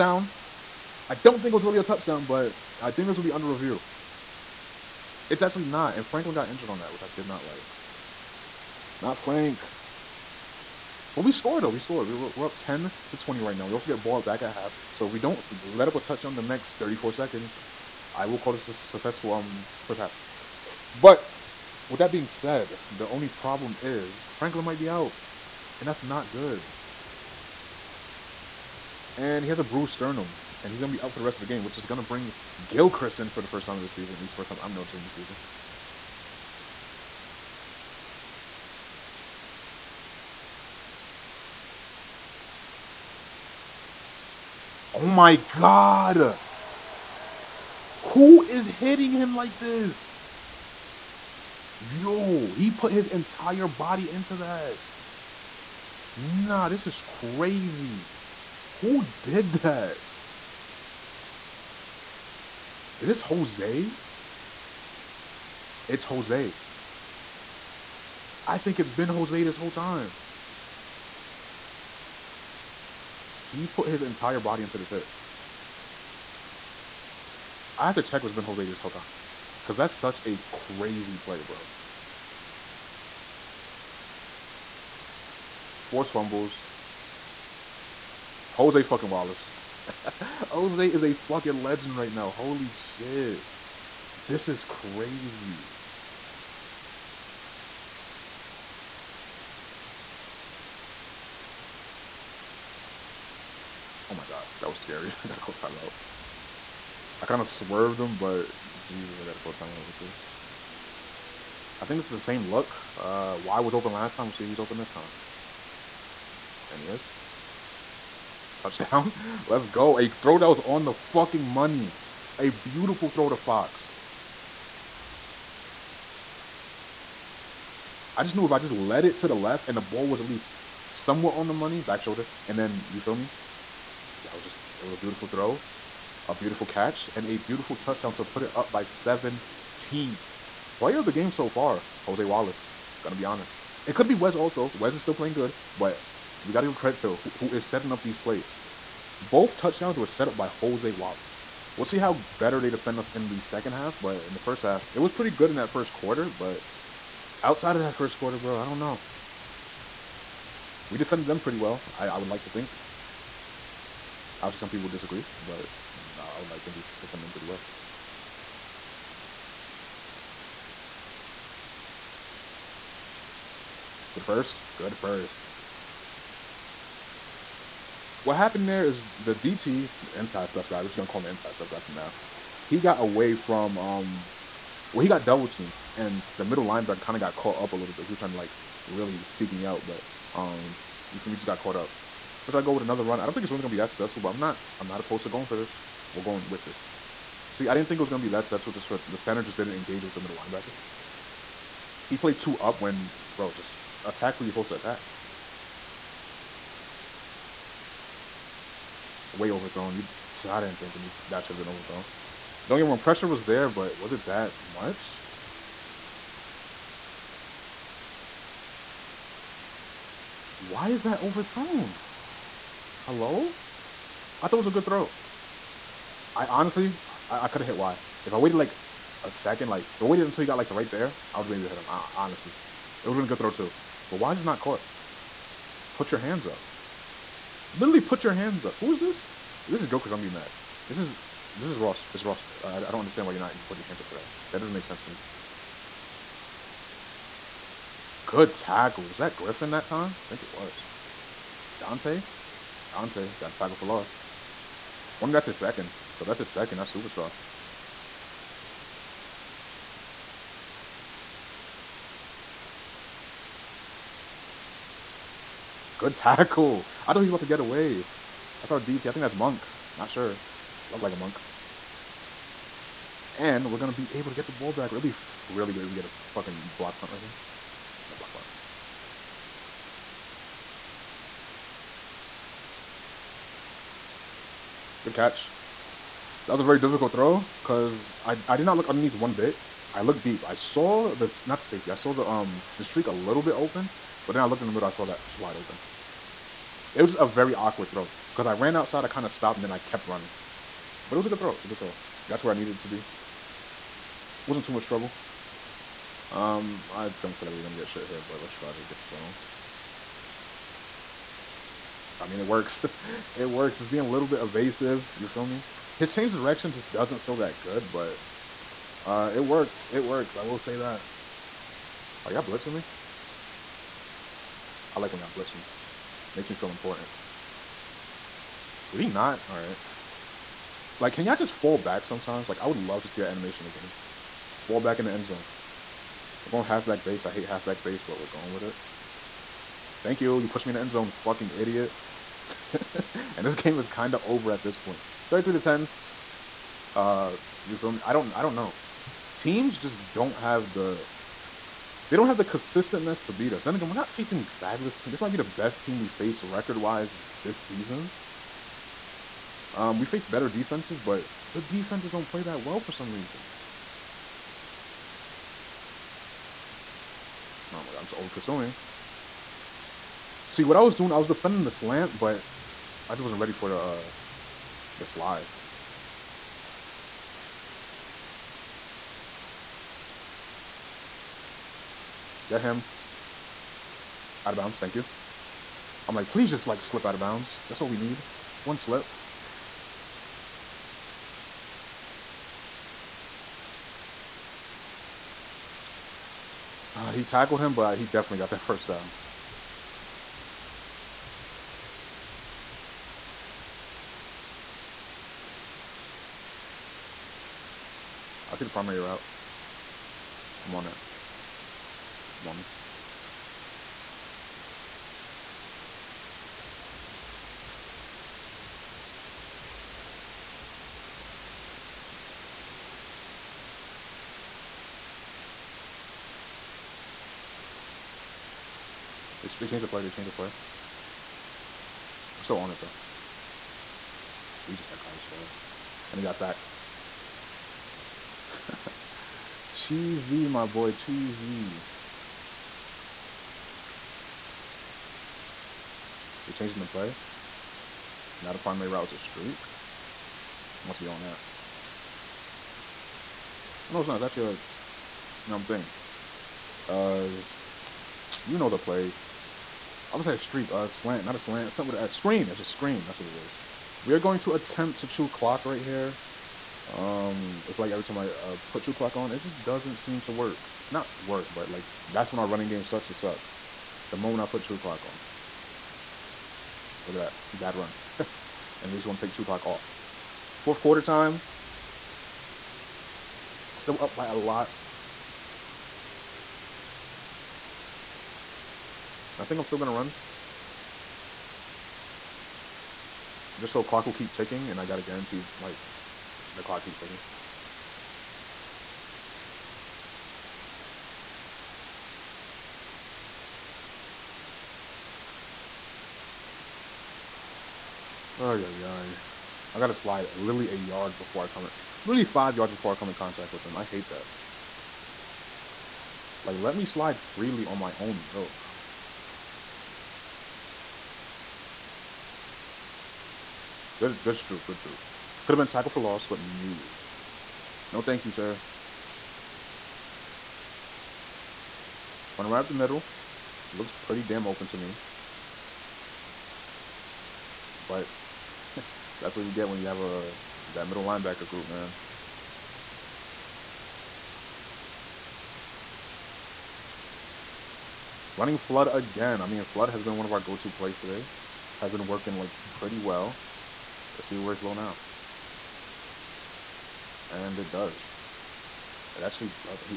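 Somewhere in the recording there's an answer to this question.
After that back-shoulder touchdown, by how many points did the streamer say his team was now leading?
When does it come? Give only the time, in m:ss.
2:18.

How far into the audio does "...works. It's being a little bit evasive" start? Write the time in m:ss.
5:13.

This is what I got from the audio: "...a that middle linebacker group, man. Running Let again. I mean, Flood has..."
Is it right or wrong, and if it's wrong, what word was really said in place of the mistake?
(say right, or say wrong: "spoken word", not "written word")
wrong: "Flood", not "Let".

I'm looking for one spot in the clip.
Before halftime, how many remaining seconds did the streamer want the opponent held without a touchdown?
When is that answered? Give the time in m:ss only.
0:16.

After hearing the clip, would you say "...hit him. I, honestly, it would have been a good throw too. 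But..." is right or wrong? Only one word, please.
right.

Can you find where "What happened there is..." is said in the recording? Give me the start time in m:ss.
2:58.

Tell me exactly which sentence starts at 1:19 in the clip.
Because that's such a crazy play, bro.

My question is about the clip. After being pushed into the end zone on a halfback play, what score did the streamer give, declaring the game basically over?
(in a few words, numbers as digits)
33 to 10.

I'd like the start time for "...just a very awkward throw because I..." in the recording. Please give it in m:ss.
4:57.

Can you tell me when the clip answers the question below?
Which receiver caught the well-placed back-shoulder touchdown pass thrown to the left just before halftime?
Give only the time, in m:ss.
2:03.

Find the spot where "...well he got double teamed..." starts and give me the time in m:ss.
3:04.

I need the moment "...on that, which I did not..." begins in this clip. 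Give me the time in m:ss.
0:06.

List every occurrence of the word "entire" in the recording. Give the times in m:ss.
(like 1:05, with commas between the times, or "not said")
0:53, 1:14.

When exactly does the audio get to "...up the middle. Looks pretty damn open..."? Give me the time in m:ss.
8:52.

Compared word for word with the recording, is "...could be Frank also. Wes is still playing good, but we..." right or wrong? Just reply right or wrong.
wrong.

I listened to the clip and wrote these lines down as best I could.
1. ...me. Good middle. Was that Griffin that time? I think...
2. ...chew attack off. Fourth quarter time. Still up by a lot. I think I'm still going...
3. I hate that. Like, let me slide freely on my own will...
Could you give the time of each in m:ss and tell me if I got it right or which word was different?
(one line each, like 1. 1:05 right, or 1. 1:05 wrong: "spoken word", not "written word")
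1. 4:05 wrong: "tackle", not "middle"
2. 7:59 wrong: "clock", not "attack"
3. 8:33 right.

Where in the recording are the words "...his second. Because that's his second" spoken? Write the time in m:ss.
4:15.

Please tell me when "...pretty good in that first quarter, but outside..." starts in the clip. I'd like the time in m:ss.
2:35.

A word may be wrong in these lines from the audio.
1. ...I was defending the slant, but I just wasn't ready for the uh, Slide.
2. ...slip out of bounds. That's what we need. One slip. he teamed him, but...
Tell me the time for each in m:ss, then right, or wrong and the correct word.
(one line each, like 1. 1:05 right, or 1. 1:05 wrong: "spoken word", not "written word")
1. 6:11 right
2. 6:26 wrong: "tackled", not "teamed".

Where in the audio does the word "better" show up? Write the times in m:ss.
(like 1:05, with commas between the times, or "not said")
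2:32, 6:00.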